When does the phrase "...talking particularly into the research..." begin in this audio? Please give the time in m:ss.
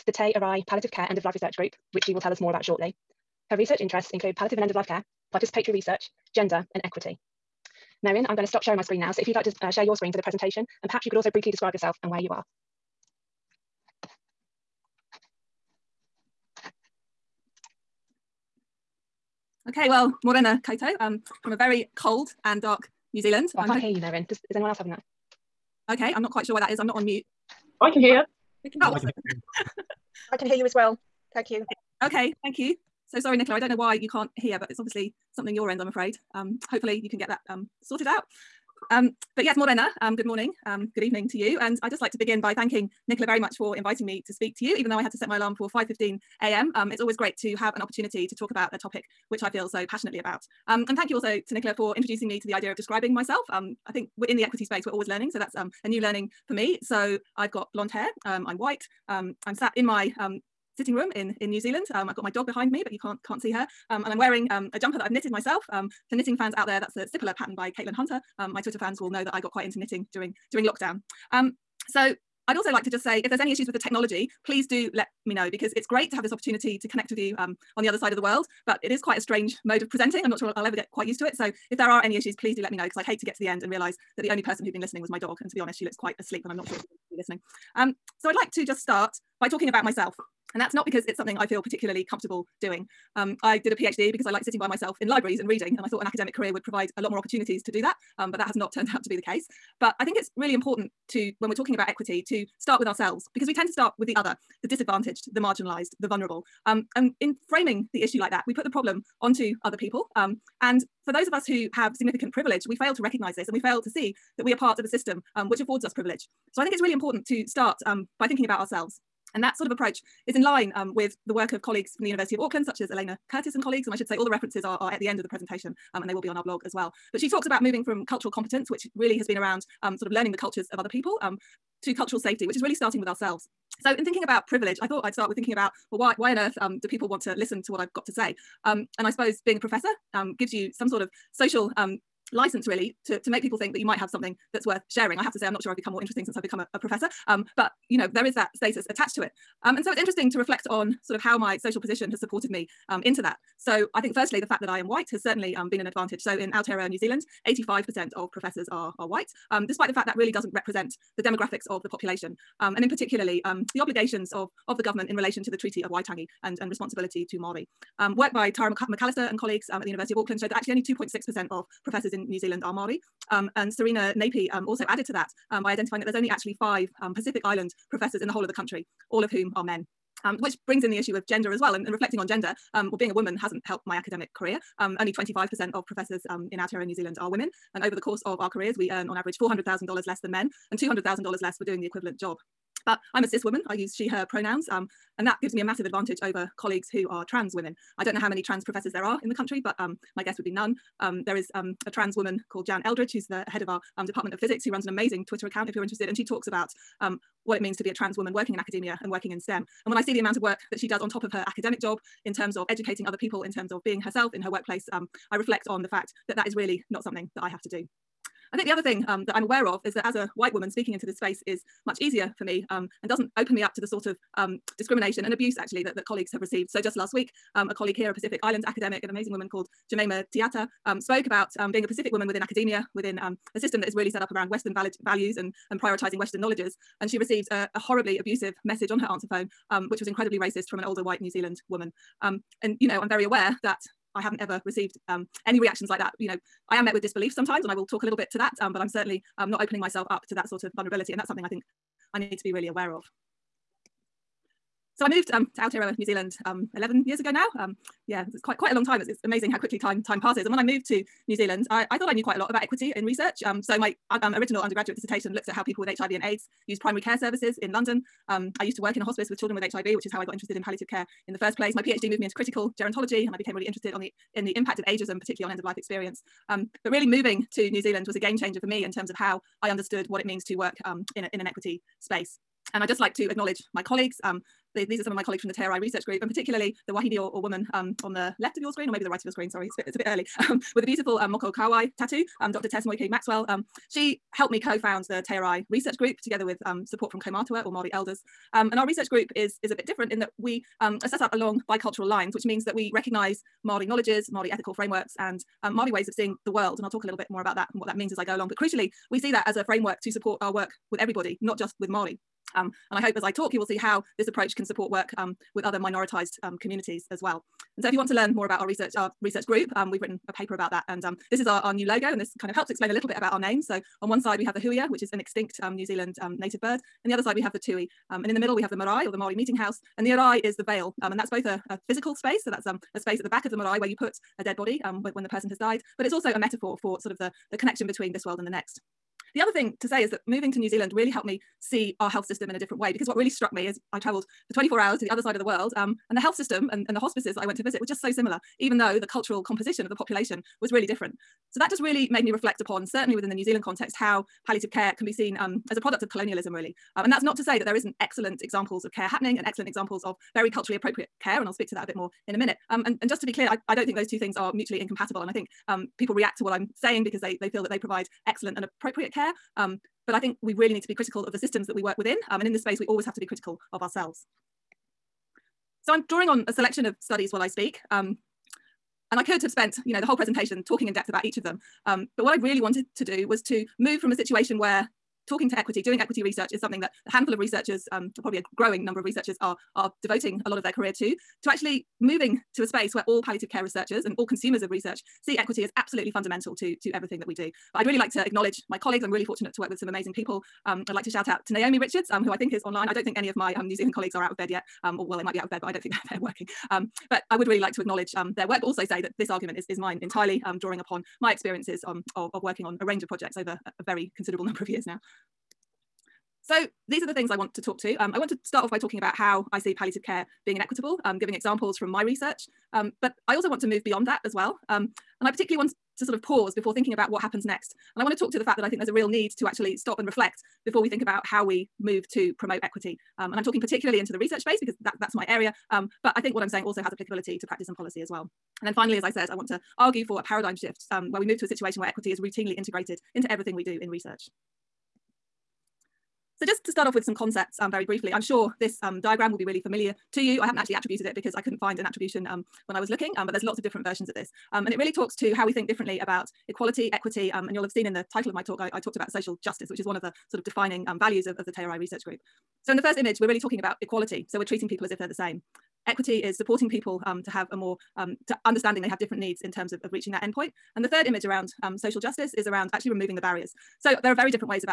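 7:13.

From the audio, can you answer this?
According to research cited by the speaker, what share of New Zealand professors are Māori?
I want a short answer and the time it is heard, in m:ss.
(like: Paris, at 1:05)
2.6%, at 2:50.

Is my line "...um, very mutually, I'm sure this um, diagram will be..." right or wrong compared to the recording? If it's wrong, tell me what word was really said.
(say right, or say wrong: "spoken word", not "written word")
wrong: "briefly", not "mutually".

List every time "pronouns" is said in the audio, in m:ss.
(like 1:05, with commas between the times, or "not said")
3:14.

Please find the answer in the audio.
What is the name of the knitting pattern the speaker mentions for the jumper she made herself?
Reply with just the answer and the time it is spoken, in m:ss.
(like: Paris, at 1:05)
Sipalu, at 1:07.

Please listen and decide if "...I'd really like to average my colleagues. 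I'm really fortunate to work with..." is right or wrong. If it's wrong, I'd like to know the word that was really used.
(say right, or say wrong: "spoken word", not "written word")
wrong: "acknowledge", not "average".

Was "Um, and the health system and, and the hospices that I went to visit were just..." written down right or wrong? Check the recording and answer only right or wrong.
right.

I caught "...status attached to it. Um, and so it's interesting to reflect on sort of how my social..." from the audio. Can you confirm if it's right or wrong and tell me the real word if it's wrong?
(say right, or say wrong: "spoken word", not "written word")
right.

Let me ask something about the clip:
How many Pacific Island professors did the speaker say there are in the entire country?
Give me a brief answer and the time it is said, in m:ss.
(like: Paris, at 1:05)
5, at 2:56.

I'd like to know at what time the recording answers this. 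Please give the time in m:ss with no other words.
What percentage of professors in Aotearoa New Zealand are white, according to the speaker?
2:37.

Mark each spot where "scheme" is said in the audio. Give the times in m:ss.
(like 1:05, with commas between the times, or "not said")
not said.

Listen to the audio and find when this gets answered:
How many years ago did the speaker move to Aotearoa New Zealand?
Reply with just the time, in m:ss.
4:16.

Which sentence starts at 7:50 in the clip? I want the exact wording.
And the third image around um, social justice is around actually removing the barriers.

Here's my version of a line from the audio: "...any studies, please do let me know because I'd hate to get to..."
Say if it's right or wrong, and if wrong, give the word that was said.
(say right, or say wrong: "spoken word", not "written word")
wrong: "issues", not "studies".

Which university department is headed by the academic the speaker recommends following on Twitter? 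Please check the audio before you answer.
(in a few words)
Department of Physics.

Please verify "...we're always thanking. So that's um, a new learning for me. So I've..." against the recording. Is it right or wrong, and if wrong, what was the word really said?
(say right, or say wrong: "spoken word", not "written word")
wrong: "learning", not "thanking".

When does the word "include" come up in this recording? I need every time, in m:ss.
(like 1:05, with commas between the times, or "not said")
0:04.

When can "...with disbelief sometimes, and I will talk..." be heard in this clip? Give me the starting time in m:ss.
4:06.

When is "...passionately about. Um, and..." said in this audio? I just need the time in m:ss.
0:49.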